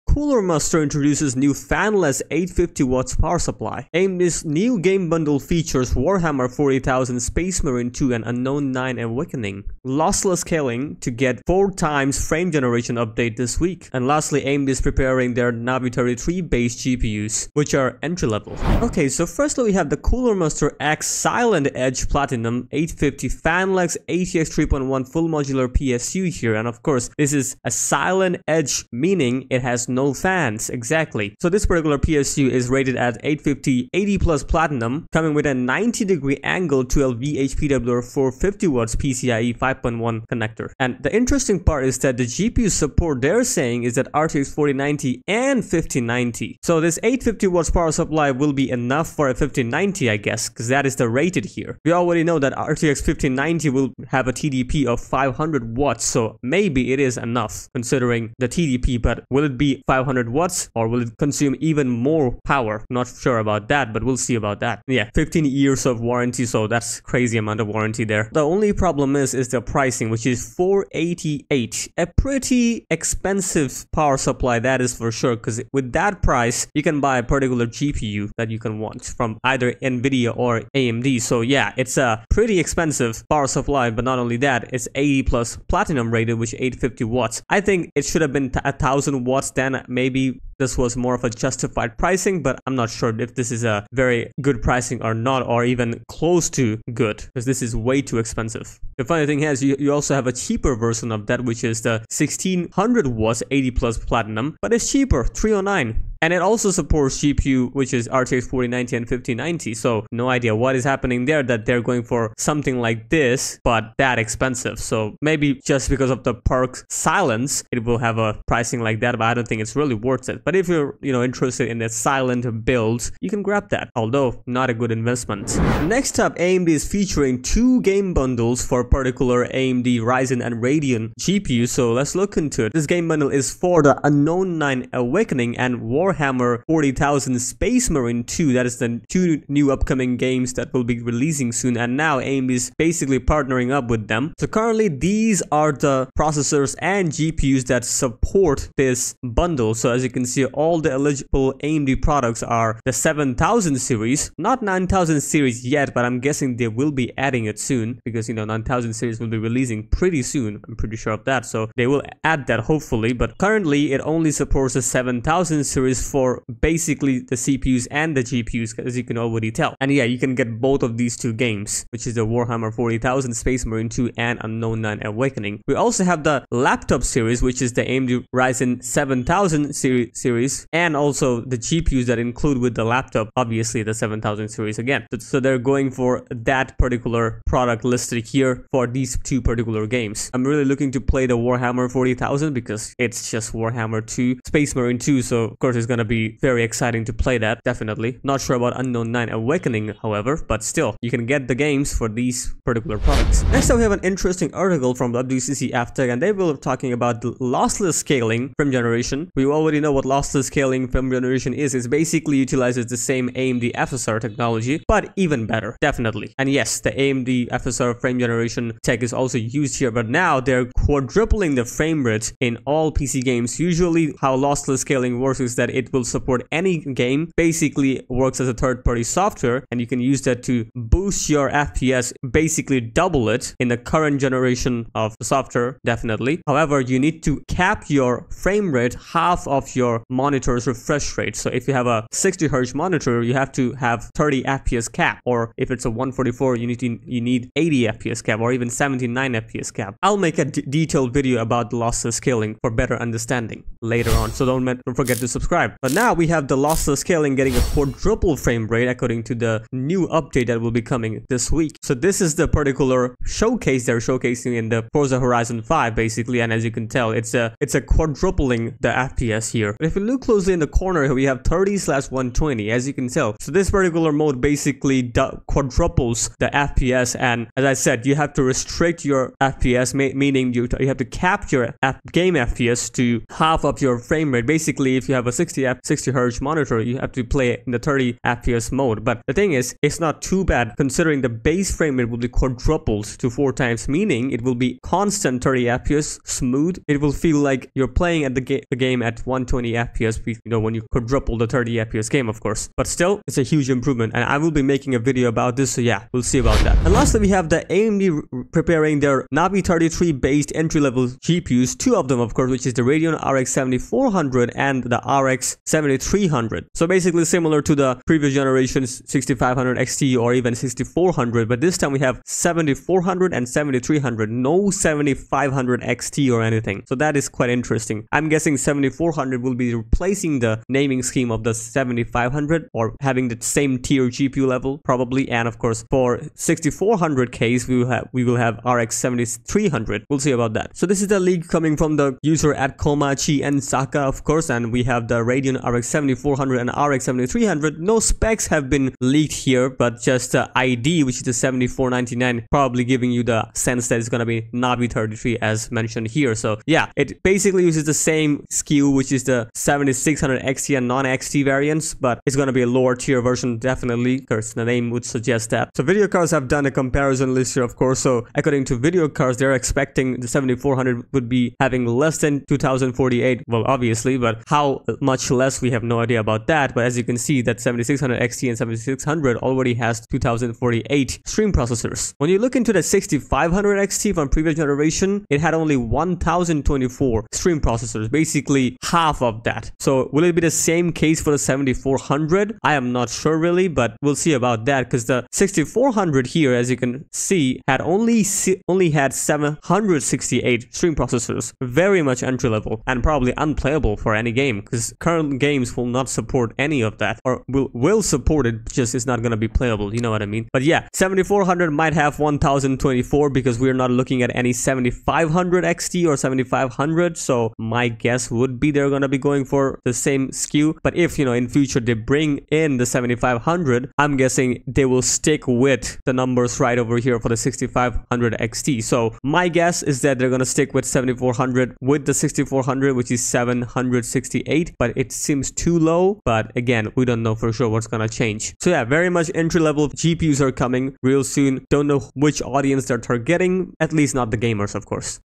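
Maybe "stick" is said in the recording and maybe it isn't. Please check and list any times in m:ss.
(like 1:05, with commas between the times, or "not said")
7:05, 7:10.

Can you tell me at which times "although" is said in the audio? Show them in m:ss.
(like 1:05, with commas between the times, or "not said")
2:03.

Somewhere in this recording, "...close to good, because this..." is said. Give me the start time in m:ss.
1:36.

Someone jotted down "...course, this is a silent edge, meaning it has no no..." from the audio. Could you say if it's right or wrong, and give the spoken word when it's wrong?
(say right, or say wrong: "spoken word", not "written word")
right.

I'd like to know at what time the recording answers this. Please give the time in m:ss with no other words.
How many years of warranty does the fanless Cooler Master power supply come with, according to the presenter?
1:05.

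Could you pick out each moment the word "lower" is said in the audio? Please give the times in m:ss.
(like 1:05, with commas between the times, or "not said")
6:02.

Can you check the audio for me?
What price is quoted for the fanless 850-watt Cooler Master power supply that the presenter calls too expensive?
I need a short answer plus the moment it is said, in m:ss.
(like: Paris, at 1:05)
488, at 1:10.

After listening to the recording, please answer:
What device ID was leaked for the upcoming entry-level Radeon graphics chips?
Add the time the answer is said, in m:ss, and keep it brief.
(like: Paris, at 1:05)
7499, at 5:51.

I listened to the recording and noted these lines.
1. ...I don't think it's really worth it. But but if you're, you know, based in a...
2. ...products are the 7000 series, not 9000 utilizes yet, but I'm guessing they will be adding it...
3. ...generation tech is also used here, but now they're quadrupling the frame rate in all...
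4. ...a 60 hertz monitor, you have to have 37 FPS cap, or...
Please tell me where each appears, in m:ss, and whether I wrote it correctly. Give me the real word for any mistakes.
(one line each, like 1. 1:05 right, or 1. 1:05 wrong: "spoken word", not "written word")
1. 1:59 wrong: "interested", not "based"
2. 2:32 wrong: "series", not "utilizes"
3. 3:38 right
4. 4:01 wrong: "30", not "37".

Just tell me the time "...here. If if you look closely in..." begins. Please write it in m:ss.
4:29.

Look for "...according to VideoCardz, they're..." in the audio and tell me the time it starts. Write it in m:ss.
6:08.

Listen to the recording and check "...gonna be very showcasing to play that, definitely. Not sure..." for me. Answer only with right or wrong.
wrong.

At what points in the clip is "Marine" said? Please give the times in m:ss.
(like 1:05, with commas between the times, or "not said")
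0:07, 2:17, 2:53, 3:14.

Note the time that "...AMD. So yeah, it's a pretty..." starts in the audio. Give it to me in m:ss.
1:20.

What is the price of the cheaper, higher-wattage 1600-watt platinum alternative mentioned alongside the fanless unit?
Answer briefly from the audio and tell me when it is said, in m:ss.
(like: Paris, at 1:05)
309, at 1:45.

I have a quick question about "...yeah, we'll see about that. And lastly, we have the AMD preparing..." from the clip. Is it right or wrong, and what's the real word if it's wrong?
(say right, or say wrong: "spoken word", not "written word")
right.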